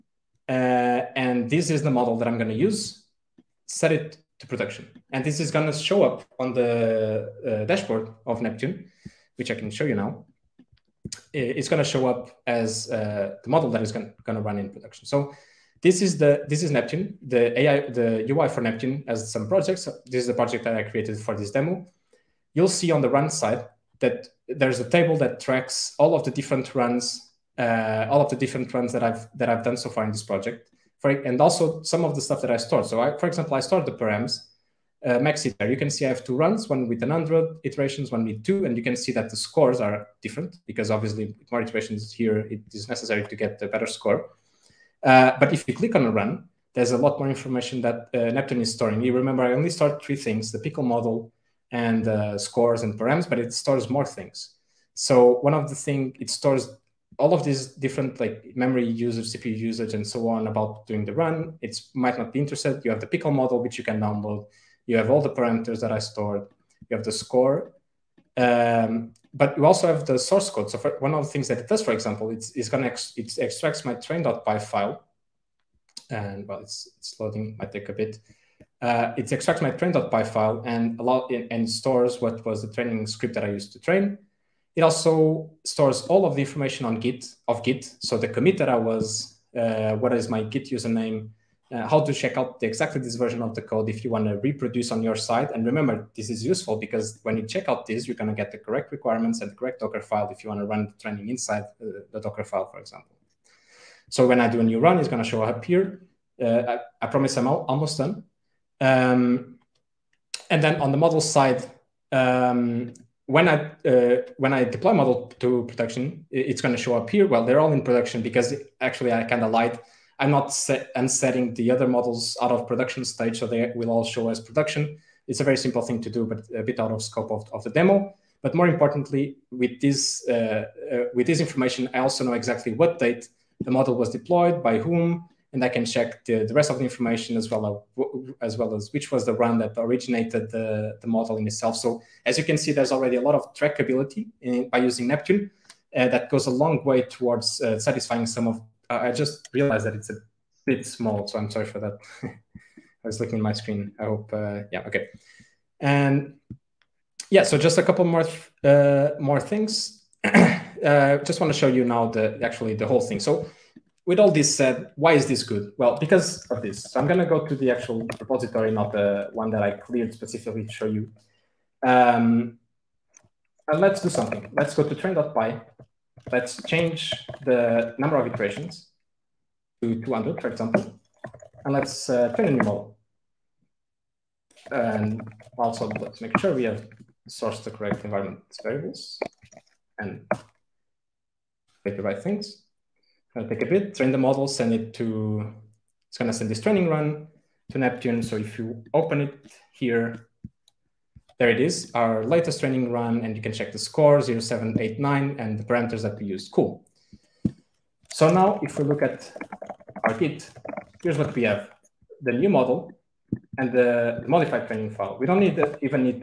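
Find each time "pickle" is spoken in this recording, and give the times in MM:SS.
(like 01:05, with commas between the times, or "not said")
00:50, 01:03.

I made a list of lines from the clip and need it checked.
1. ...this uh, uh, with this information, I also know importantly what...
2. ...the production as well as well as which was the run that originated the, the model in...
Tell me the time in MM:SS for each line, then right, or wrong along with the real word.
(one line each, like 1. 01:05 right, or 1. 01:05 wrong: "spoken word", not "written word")
1. 02:09 wrong: "exactly", not "importantly"
2. 02:16 wrong: "information", not "production".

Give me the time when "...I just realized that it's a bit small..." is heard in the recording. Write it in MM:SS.
02:29.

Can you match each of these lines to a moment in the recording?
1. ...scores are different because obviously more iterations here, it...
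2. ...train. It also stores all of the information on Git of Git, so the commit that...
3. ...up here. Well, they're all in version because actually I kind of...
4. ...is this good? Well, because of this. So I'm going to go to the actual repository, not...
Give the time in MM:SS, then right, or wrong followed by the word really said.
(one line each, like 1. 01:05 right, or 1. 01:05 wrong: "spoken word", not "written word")
1. 00:39 right
2. 01:23 right
3. 01:56 wrong: "production", not "version"
4. 02:45 right.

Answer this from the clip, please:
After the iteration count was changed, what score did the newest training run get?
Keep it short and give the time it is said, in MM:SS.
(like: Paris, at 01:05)
0789, at 03:24.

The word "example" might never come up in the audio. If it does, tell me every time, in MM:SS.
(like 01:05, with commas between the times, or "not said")
00:33, 01:11, 01:42, 03:00.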